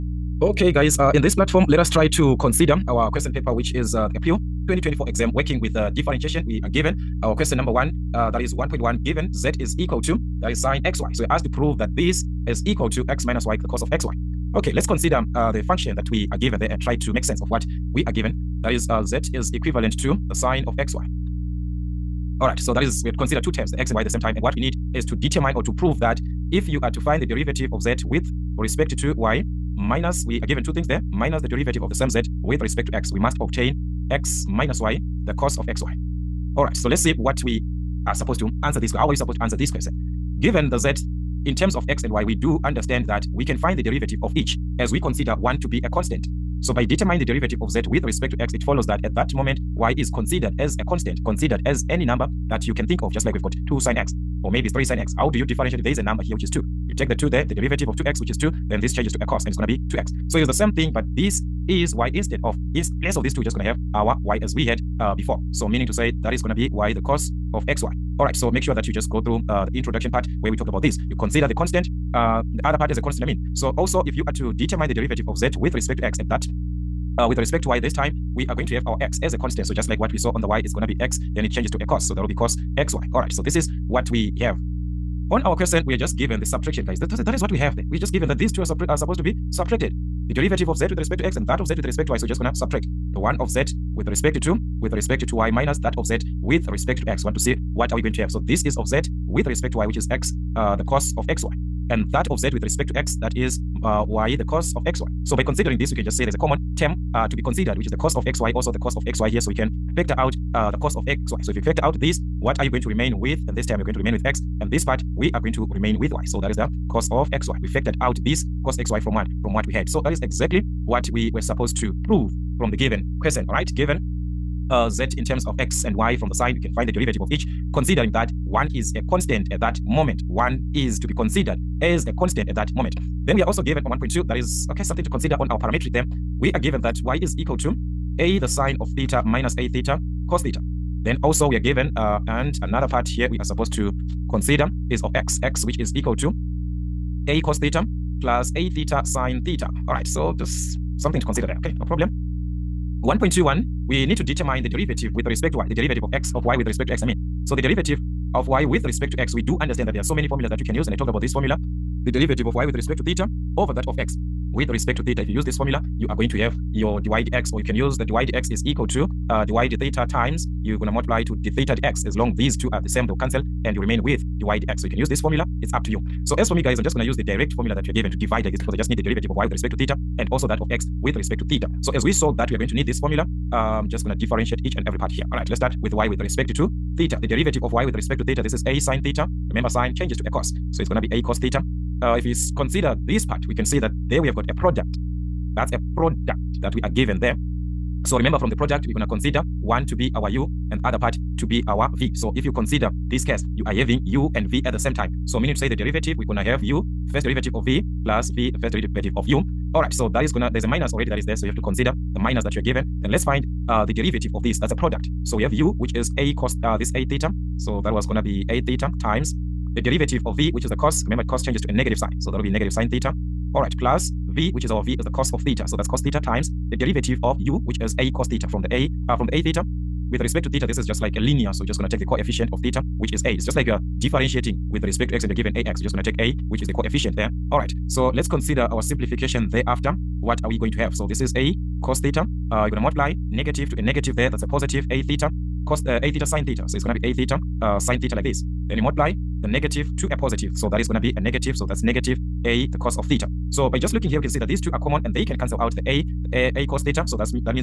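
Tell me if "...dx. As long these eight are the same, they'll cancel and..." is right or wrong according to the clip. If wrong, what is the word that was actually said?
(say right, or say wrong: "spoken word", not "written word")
wrong: "two", not "eight".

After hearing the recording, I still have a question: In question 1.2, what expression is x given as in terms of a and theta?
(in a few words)
a cos theta plus a theta sine theta.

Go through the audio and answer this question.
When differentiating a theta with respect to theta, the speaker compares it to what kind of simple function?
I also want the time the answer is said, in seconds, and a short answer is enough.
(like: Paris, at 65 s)
linear, at 231 s.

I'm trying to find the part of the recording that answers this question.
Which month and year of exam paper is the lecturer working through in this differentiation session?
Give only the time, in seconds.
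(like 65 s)
4 s.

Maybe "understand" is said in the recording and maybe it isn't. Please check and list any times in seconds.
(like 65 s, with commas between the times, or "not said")
42 s, 159 s.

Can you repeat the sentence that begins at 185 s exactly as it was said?
All right, let's start with y with respect to theta.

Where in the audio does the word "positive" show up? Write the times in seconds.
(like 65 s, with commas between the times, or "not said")
244 s, 250 s.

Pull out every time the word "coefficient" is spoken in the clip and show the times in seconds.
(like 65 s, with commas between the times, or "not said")
232 s, 236 s.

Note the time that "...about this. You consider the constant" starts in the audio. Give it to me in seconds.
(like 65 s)
70 s.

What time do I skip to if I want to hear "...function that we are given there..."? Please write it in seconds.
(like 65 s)
15 s.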